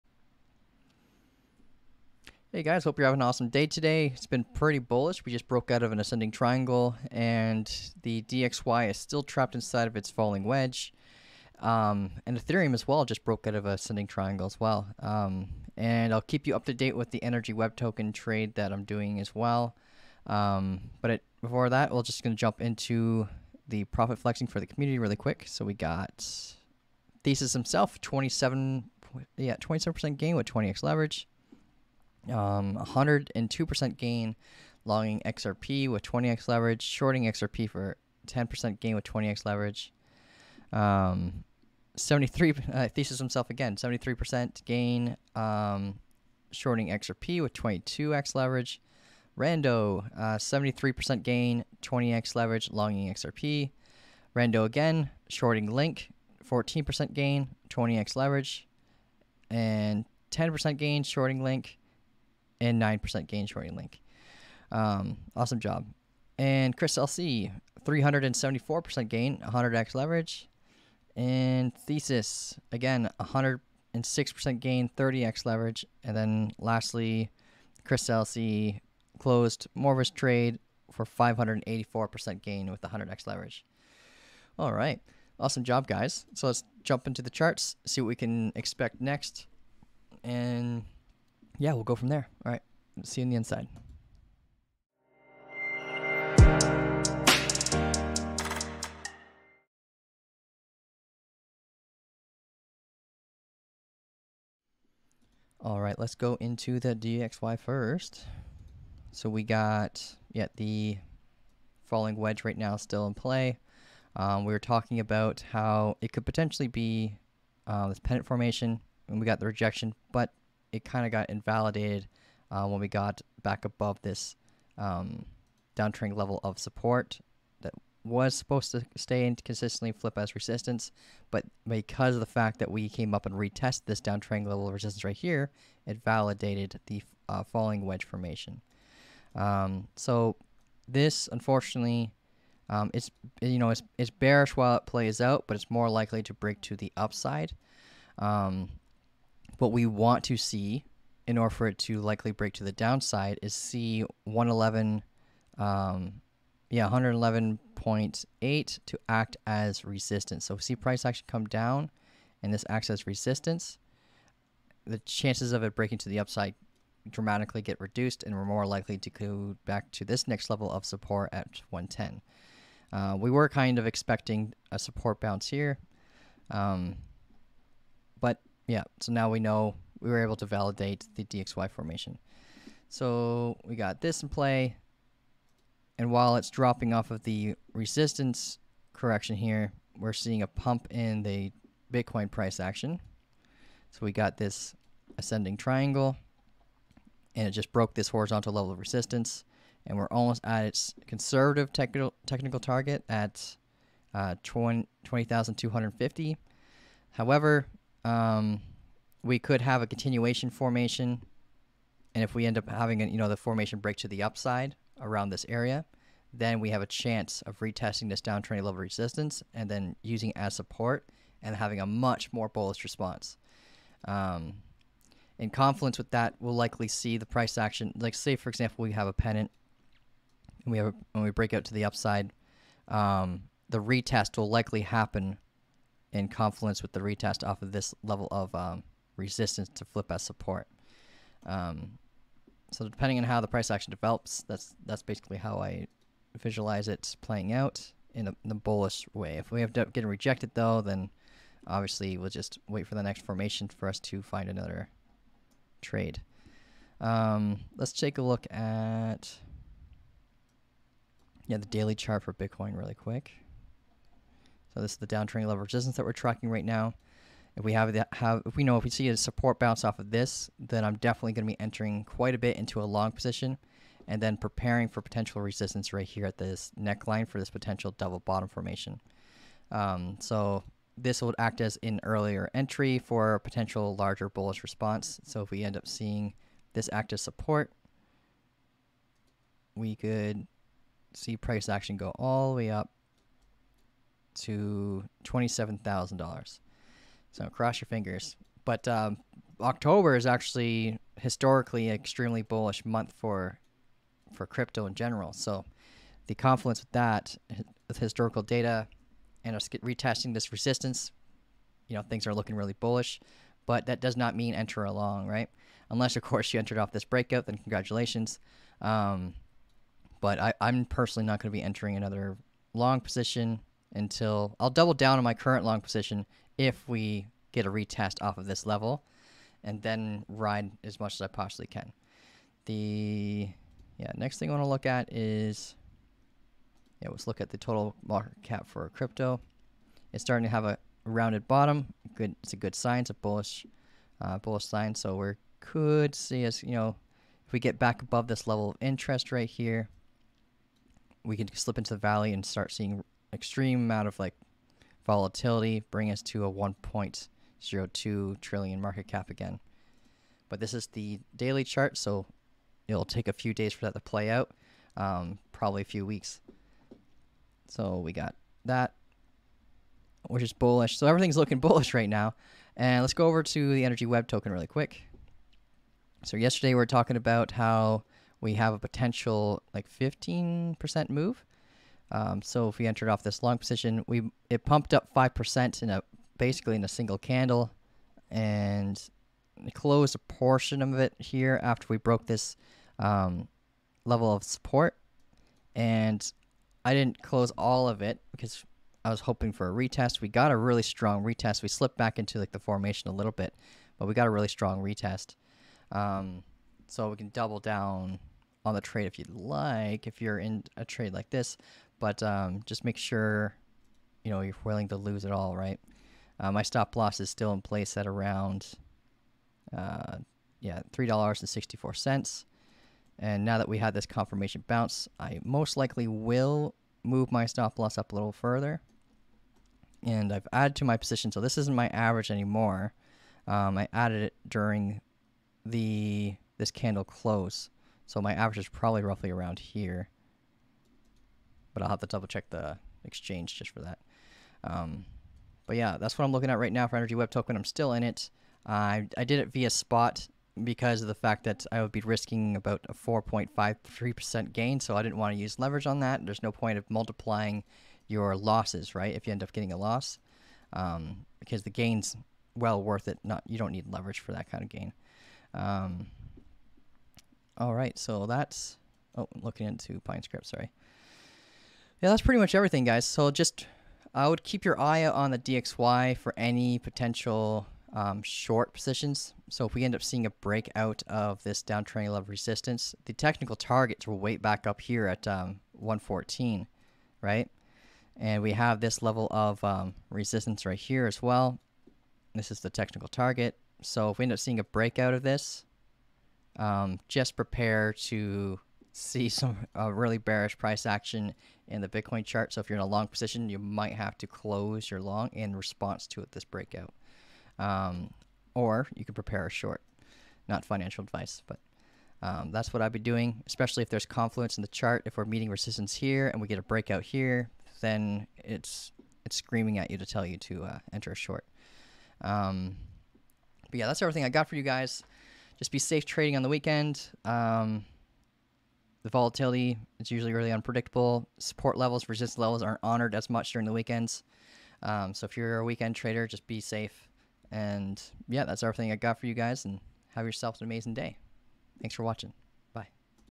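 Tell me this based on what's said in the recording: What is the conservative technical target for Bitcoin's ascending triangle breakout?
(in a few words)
20,250.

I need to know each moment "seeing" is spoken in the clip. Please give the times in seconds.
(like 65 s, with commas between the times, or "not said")
190 s, 285 s, 352 s, 480 s, 494 s.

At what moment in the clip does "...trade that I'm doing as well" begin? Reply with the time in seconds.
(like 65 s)
18 s.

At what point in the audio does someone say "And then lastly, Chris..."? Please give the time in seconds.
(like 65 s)
76 s.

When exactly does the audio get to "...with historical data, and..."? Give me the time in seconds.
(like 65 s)
307 s.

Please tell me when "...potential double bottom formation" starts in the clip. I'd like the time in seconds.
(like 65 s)
277 s.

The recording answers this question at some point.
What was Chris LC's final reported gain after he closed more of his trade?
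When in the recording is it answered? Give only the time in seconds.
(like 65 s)
81 s.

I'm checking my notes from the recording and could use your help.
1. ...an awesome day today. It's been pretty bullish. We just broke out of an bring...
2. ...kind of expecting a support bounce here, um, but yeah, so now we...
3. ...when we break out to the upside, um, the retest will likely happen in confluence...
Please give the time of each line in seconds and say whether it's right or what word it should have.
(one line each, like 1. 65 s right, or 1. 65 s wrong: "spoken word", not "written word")
1. 3 s wrong: "ascending", not "bring"
2. 173 s right
3. 231 s right.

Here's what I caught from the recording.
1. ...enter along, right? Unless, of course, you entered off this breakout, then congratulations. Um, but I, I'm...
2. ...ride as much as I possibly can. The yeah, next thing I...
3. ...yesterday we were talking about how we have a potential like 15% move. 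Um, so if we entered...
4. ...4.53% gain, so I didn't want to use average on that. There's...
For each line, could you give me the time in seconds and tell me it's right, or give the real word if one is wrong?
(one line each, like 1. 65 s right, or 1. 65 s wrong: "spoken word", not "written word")
1. 314 s right
2. 330 s right
3. 376 s right
4. 452 s wrong: "leverage", not "average".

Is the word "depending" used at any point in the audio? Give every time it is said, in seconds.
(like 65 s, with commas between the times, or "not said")
242 s.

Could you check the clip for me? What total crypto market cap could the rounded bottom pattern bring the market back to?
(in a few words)
1.02 trillion.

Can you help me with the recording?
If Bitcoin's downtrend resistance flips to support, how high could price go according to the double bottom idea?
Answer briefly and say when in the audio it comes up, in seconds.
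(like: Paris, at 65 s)
$27,000, at 295 s.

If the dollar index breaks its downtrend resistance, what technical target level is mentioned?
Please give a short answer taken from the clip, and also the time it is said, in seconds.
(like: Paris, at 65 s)
114, at 485 s.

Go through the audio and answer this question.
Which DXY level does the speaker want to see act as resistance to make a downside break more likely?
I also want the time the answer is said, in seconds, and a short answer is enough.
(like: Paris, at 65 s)
111.8, at 156 s.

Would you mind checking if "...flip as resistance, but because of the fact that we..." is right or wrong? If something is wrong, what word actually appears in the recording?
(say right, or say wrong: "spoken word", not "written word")
right.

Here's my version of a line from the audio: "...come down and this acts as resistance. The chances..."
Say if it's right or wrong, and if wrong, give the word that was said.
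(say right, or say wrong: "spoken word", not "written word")
right.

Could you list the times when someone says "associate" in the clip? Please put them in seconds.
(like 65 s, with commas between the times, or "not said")
not said.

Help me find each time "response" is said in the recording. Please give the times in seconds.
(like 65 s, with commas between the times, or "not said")
222 s, 284 s, 505 s.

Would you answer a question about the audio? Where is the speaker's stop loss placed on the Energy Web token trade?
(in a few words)
$3.64.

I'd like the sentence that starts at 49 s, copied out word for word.
Rando uh, 73% gain, 20x leverage, longing XRP.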